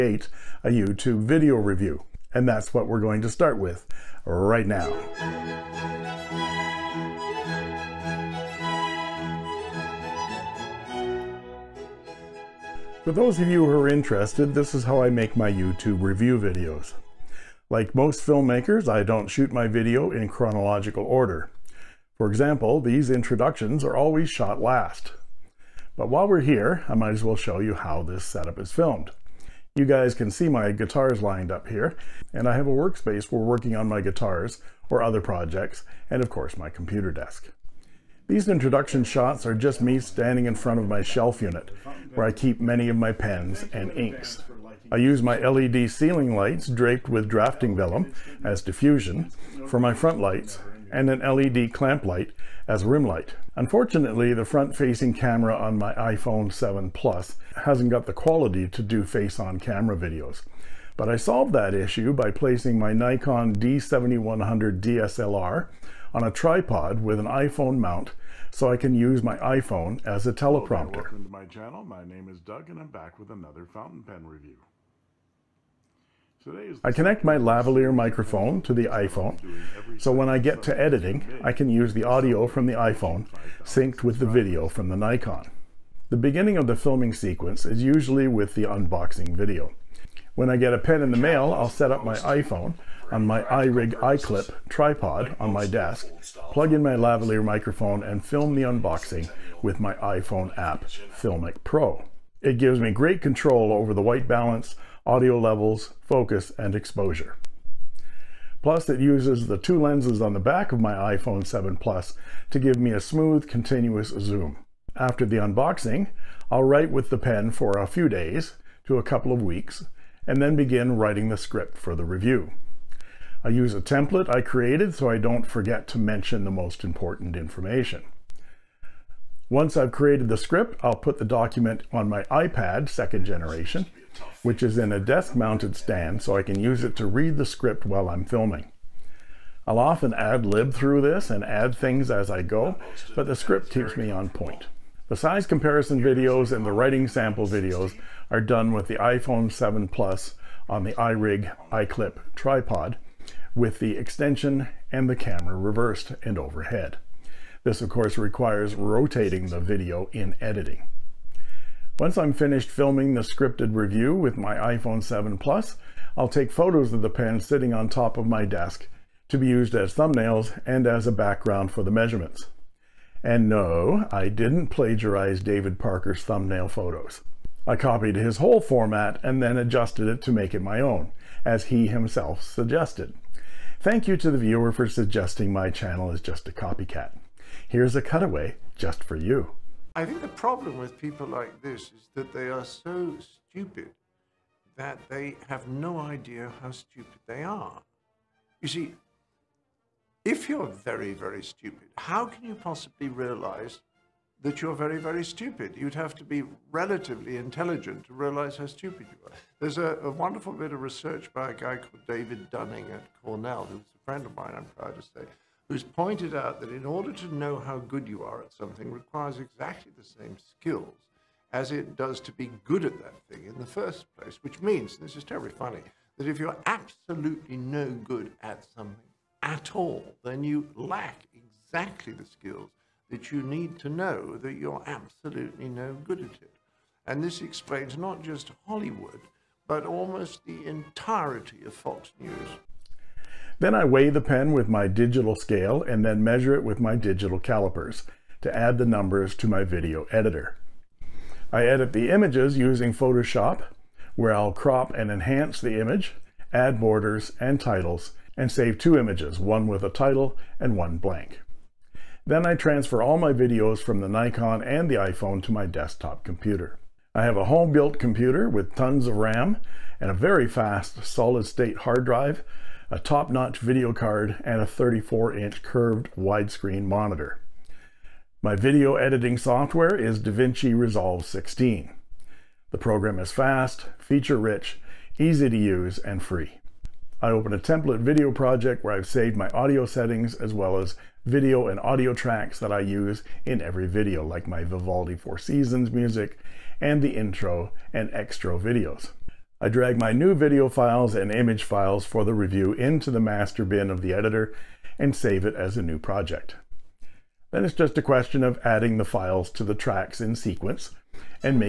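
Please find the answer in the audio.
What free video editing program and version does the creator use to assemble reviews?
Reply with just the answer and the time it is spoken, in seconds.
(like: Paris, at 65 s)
DaVinci Resolve 16, at 280 s.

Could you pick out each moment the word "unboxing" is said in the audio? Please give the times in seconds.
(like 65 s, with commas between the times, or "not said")
88 s, 98 s, 115 s.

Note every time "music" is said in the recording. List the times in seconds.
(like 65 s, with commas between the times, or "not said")
295 s.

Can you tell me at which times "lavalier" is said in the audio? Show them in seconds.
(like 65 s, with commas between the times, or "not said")
77 s, 96 s.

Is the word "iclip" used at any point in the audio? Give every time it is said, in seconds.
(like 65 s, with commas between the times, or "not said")
94 s, 151 s.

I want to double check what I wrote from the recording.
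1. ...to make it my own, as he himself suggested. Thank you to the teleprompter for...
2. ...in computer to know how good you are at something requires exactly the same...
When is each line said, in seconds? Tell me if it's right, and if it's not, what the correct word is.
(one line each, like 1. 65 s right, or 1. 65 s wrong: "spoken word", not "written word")
1. 180 s wrong: "viewer", not "teleprompter"
2. 216 s wrong: "order", not "computer".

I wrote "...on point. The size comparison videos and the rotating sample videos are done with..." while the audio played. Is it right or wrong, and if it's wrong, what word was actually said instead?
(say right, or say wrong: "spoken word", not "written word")
wrong: "writing", not "rotating".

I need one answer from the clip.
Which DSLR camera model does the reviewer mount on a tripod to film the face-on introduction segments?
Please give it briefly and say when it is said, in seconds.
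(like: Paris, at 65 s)
Nikon D7100, at 62 s.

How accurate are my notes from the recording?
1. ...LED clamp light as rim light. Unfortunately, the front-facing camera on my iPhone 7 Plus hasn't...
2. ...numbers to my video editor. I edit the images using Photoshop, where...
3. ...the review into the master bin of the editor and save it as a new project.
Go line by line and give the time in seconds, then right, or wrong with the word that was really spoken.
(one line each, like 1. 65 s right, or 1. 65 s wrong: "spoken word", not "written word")
1. 51 s right
2. 248 s right
3. 302 s right.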